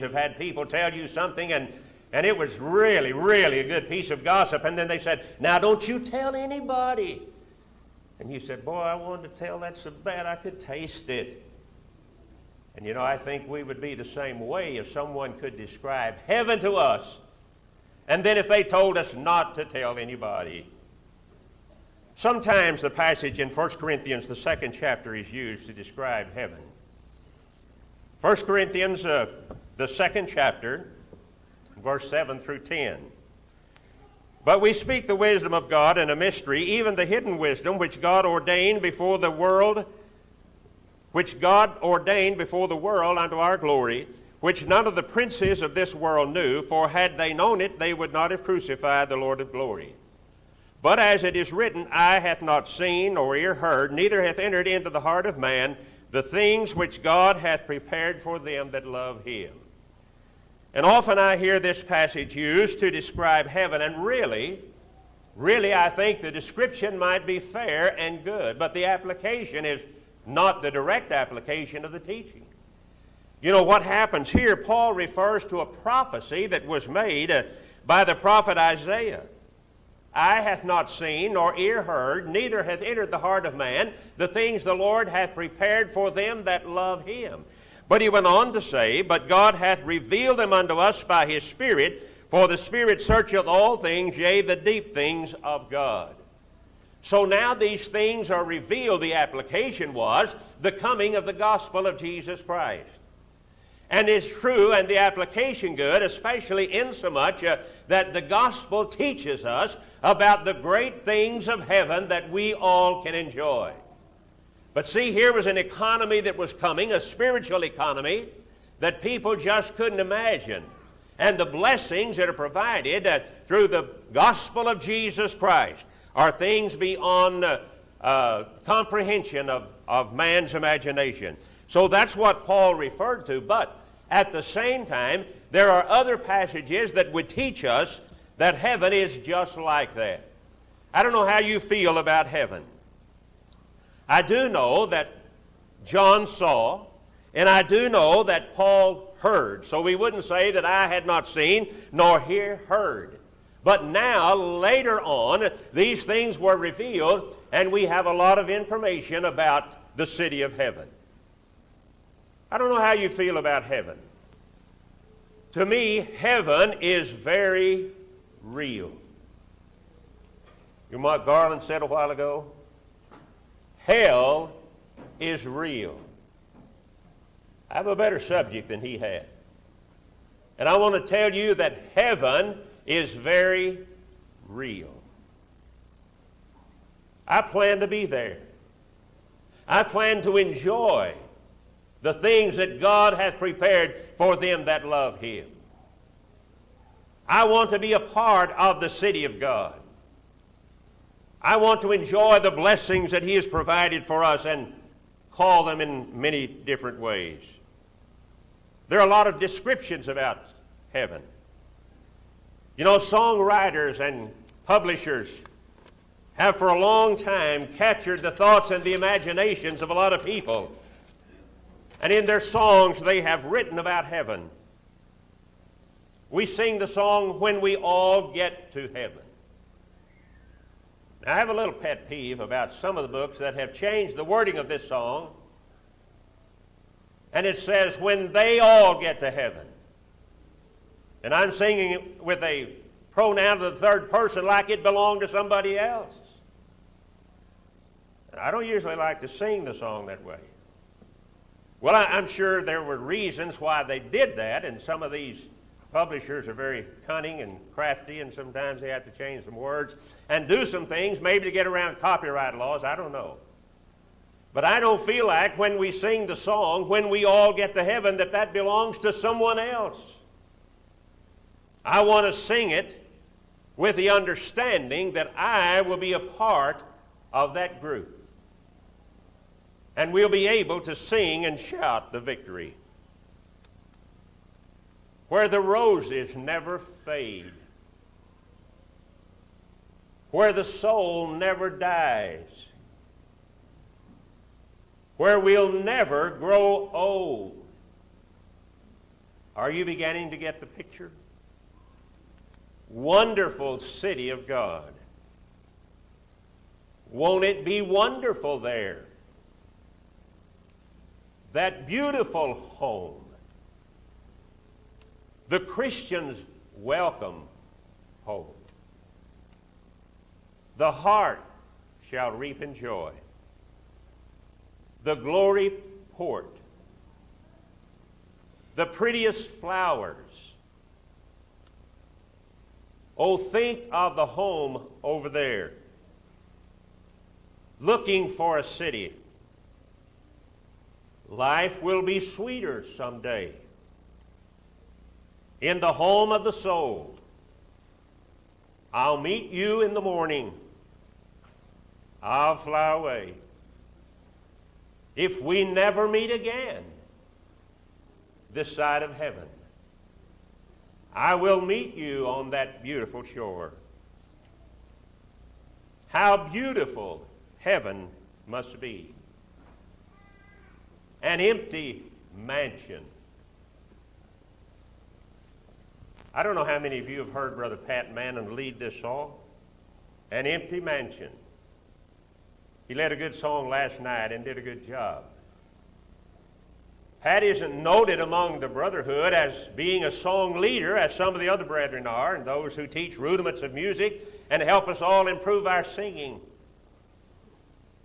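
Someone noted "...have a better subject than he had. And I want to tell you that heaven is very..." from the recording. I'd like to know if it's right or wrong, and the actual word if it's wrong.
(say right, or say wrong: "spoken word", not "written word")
right.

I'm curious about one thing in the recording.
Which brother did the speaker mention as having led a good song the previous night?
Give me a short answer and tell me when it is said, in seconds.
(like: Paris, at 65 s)
Pat Mannon, at 377 s.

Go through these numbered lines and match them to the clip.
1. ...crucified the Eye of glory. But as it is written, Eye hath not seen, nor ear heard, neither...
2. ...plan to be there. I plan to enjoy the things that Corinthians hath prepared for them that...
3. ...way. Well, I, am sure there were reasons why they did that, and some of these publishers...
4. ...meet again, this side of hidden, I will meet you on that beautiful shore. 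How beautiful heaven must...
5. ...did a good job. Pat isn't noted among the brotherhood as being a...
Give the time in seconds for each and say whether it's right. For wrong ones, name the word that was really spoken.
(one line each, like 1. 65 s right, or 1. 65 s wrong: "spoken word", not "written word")
1. 48 s wrong: "Lord", not "Eye"
2. 187 s wrong: "God", not "Corinthians"
3. 250 s right
4. 356 s wrong: "heaven", not "hidden"
5. 384 s right.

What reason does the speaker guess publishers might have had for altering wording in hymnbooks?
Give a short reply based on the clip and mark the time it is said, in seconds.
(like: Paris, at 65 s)
copyright laws, at 261 s.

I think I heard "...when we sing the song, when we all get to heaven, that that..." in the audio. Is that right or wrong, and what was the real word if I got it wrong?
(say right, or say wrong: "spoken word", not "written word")
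right.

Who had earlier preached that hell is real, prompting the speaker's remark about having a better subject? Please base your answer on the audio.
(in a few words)
Garland.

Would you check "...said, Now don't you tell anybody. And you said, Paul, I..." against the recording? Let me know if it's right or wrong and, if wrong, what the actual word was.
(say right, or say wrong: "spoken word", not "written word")
wrong: "Boy", not "Paul".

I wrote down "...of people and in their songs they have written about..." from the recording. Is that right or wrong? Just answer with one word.
right.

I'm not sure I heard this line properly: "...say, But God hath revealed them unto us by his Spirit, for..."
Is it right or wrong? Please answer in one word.
right.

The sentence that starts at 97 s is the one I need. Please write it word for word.
So now these things are revealed.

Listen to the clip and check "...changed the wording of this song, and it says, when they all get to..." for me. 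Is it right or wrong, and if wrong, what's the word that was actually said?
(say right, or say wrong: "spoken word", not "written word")
right.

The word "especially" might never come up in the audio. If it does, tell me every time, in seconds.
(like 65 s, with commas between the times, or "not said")
106 s.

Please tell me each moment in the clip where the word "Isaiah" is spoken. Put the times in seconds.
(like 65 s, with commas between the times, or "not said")
78 s.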